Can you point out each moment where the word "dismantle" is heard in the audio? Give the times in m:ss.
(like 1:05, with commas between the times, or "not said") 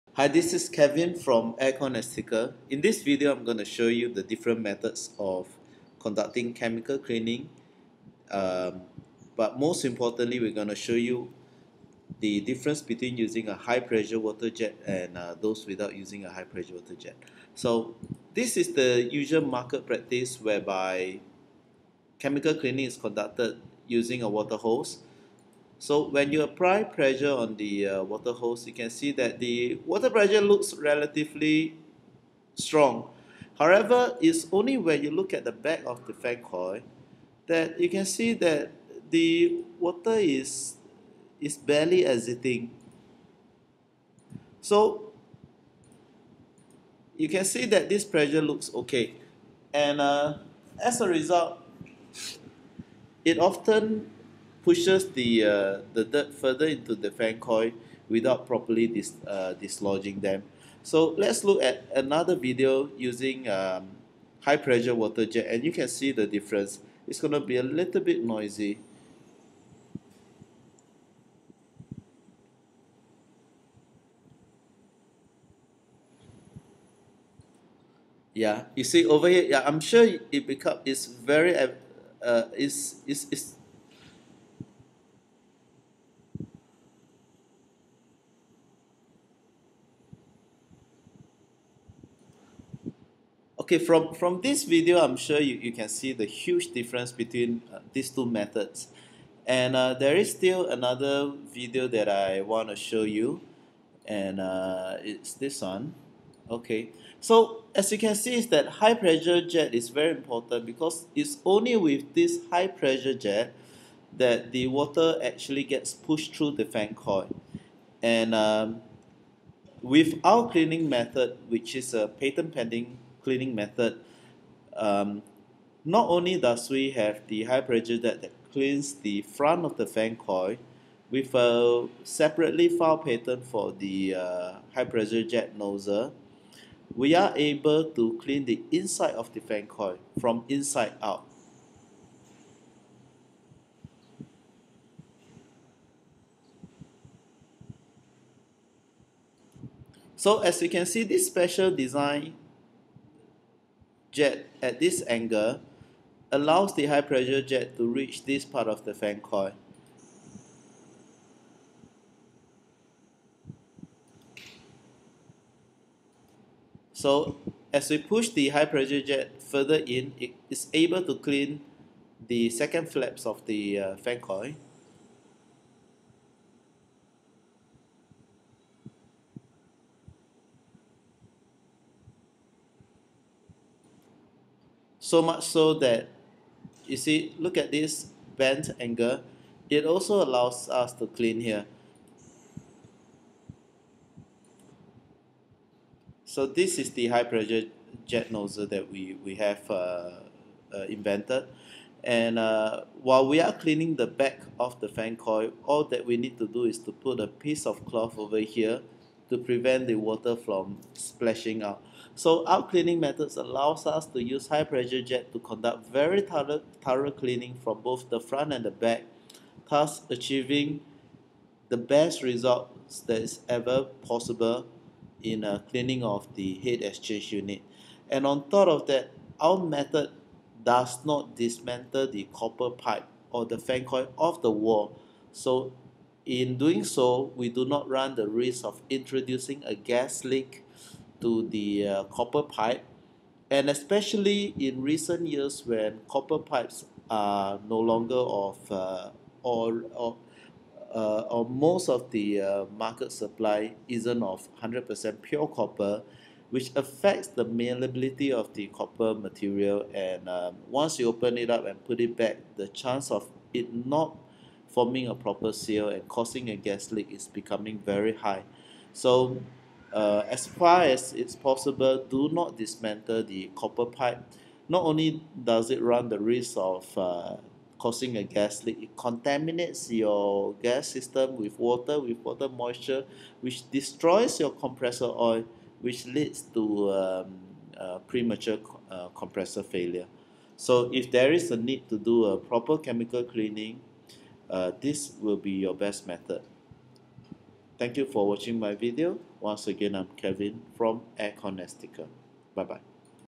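3:51, 4:32.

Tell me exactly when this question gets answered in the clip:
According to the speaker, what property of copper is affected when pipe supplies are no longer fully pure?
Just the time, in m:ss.
4:17.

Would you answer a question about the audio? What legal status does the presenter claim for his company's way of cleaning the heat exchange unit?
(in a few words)
Patent pending.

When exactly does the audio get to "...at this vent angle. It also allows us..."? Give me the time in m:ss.
3:07.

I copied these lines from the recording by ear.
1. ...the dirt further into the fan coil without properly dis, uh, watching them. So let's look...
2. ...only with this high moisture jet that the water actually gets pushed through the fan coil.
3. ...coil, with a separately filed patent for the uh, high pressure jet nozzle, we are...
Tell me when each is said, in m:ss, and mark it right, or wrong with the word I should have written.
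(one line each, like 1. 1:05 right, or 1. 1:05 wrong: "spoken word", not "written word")
1. 0:55 wrong: "dislodging", not "watching"
2. 1:51 wrong: "pressure", not "moisture"
3. 2:10 right.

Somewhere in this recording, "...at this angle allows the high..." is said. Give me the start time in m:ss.
2:34.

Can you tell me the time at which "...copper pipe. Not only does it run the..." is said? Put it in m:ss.
4:33.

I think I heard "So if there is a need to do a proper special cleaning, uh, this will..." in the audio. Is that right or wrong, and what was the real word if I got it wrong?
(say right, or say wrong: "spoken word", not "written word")
wrong: "chemical", not "special".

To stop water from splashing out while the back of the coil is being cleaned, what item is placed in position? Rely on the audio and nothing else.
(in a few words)
A piece of cloth.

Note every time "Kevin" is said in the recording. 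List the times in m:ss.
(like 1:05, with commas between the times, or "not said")
0:00, 5:00.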